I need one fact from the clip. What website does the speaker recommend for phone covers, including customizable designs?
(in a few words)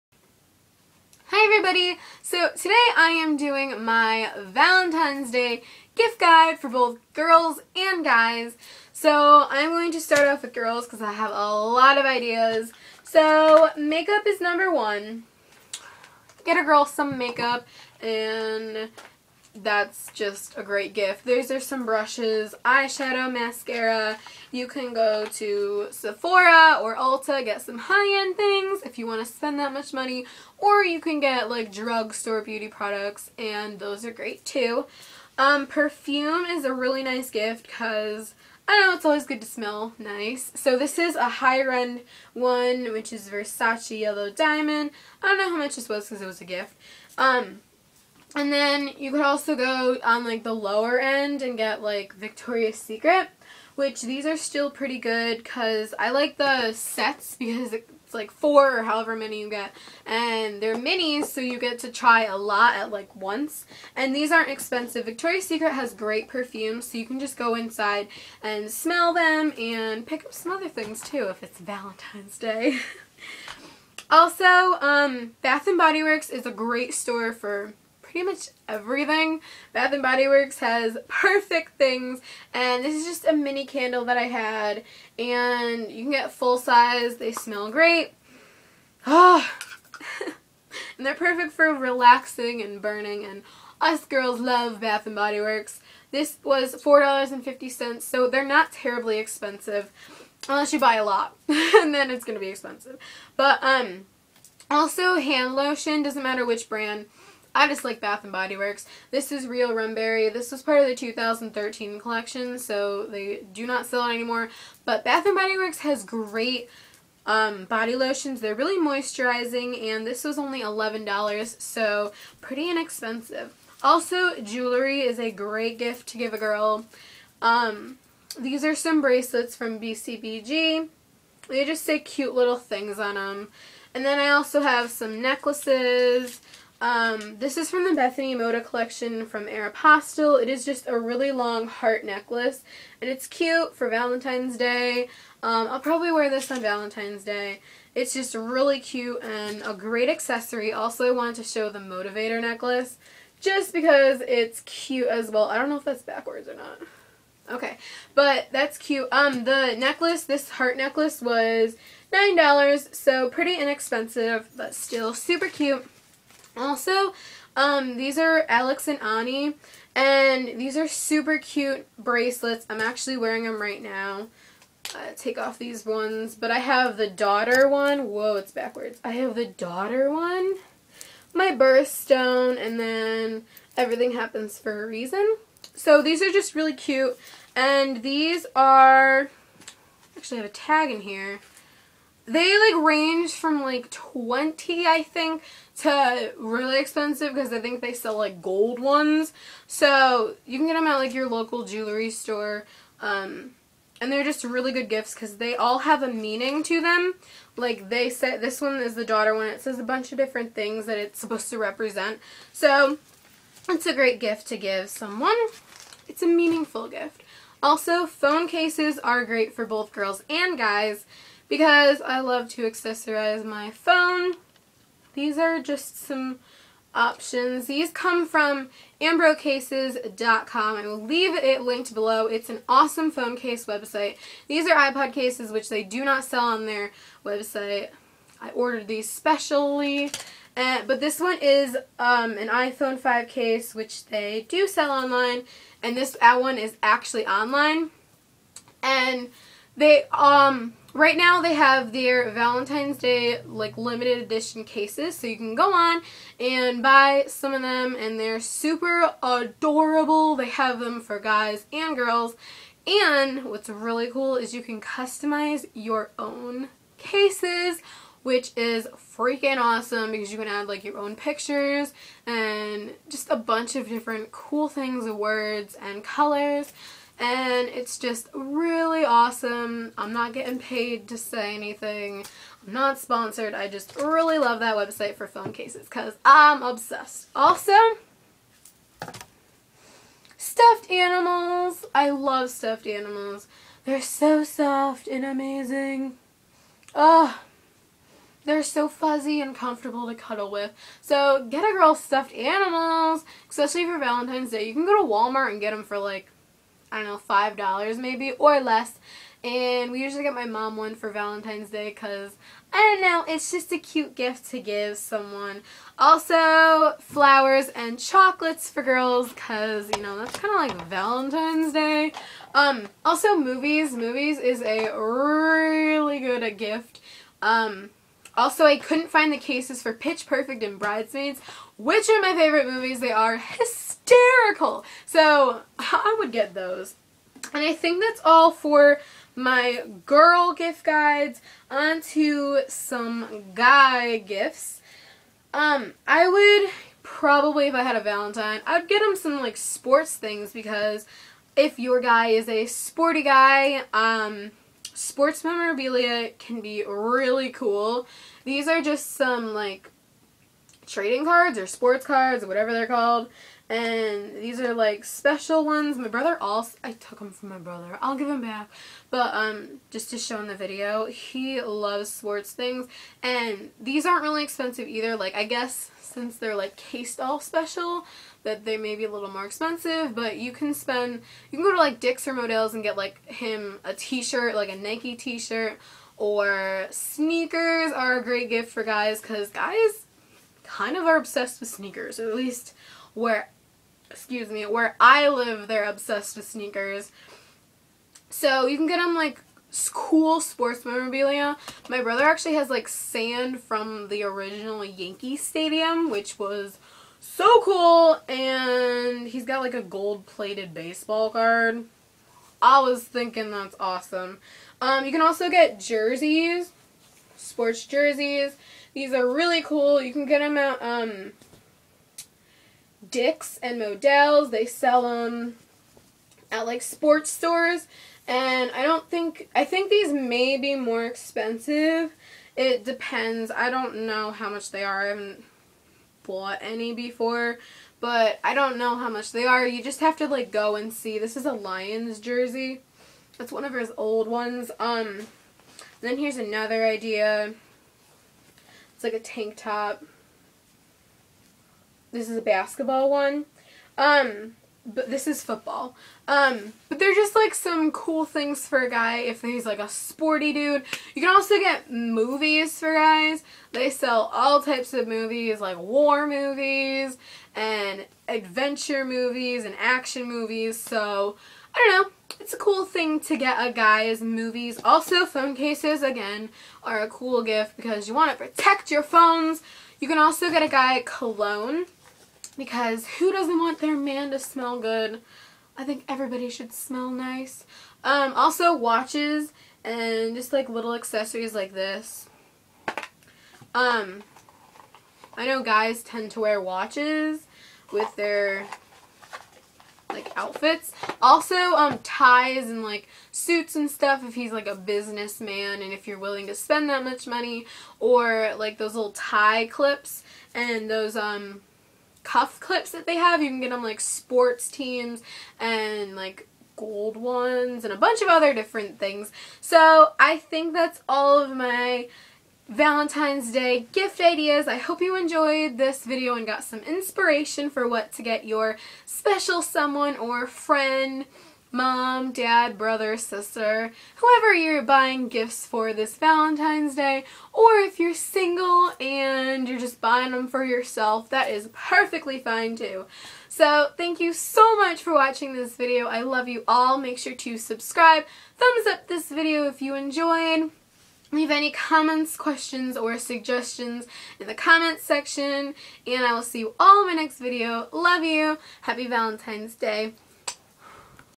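ambrocases.com.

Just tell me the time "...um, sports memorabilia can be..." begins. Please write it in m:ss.
5:53.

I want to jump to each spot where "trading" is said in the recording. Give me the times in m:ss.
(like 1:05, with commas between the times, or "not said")
6:00.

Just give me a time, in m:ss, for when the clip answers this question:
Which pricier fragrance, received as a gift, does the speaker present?
0:43.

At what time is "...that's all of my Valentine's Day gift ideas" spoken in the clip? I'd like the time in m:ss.
8:40.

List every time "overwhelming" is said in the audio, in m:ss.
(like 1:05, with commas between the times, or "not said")
not said.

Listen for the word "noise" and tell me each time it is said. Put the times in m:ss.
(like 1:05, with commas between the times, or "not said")
not said.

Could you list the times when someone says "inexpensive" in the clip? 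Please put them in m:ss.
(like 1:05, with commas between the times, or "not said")
2:02, 2:43.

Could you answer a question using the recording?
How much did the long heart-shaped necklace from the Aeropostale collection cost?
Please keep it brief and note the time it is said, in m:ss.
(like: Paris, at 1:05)
$9, at 2:42.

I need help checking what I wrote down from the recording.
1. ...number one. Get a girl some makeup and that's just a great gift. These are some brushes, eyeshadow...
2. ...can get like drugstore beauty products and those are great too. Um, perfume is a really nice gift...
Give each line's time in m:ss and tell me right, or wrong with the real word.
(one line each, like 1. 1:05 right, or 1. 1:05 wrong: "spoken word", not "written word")
1. 0:14 right
2. 0:30 right.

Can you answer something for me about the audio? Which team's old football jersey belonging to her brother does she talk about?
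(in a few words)
Lions.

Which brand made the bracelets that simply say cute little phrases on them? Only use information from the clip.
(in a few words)
BCBG.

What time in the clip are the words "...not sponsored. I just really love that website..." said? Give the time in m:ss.
4:42.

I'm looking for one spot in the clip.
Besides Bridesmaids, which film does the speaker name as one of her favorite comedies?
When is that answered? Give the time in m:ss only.
5:29.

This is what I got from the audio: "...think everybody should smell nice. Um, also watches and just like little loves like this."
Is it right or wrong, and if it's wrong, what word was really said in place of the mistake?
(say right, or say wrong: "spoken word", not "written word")
wrong: "accessories", not "loves".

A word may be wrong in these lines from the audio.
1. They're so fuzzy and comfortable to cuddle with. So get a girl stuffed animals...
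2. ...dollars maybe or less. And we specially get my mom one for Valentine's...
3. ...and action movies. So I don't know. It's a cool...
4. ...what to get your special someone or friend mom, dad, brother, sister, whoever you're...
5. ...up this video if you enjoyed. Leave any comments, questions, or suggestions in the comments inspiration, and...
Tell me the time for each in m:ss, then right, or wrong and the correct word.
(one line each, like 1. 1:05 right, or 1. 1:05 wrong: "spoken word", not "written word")
1. 4:58 right
2. 5:07 wrong: "usually", not "specially"
3. 7:49 right
4. 8:47 right
5. 9:08 wrong: "section", not "inspiration".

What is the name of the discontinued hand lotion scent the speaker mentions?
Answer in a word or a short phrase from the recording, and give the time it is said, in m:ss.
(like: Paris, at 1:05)
Rumberry, at 1:49.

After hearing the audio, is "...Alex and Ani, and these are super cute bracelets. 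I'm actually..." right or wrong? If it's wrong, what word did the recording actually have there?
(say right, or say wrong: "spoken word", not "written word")
right.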